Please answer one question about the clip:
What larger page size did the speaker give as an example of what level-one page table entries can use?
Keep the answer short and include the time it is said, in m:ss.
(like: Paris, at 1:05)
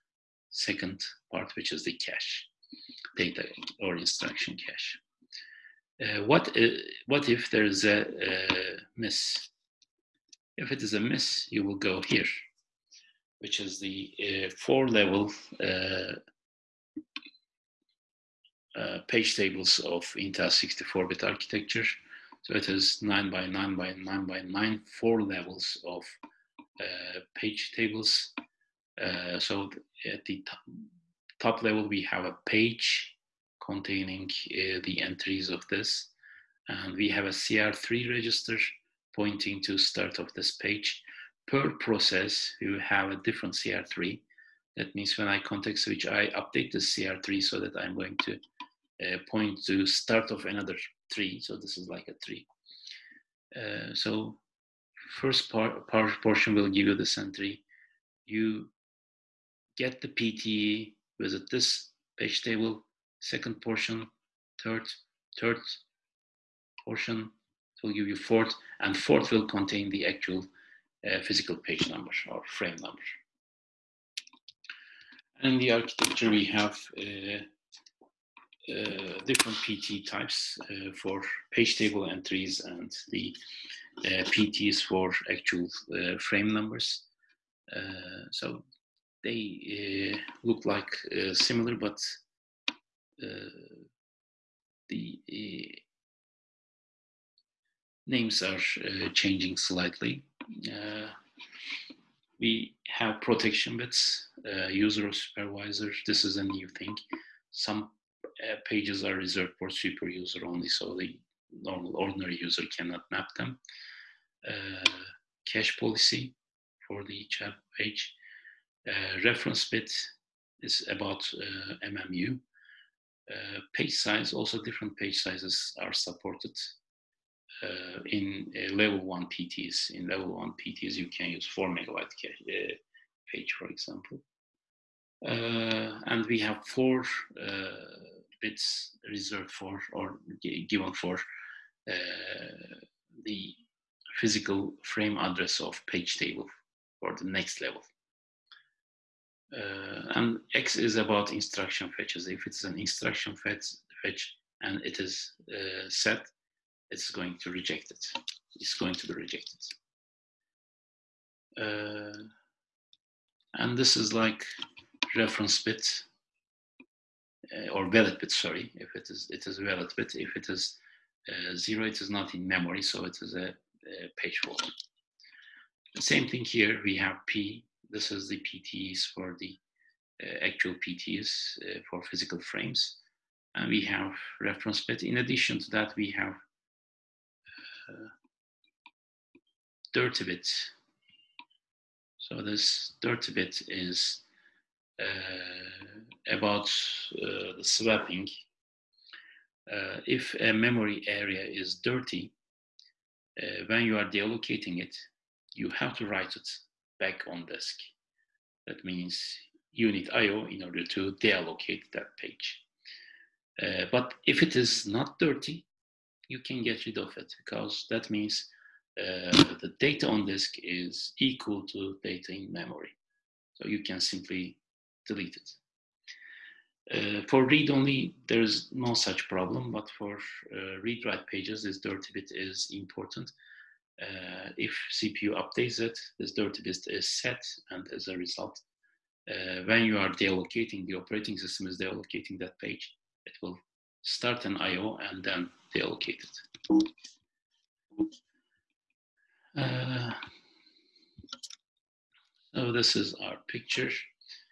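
4 megabytes, at 2:11.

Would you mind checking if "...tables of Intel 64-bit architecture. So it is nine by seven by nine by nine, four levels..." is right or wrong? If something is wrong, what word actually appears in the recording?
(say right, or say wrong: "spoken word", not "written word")
wrong: "nine", not "seven".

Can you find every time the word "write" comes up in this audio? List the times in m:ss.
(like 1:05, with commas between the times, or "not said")
3:26, 3:50.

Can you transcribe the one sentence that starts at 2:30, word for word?
and X is about instruction fetches.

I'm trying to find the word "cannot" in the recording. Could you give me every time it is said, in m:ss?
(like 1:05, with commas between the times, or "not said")
1:52.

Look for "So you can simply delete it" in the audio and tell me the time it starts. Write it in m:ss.
3:43.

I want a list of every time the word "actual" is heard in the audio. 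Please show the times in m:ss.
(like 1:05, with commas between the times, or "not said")
1:10, 1:25, 3:00.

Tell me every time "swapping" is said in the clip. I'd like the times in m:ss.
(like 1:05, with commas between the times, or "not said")
3:17.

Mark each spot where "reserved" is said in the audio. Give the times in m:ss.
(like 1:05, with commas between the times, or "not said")
1:49, 2:19.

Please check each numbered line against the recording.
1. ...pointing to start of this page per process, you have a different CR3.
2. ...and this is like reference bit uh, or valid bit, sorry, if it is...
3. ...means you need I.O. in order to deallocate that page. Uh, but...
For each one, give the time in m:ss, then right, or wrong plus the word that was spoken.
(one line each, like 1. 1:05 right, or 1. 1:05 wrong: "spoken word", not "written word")
1. 0:39 right
2. 2:43 right
3. 3:28 right.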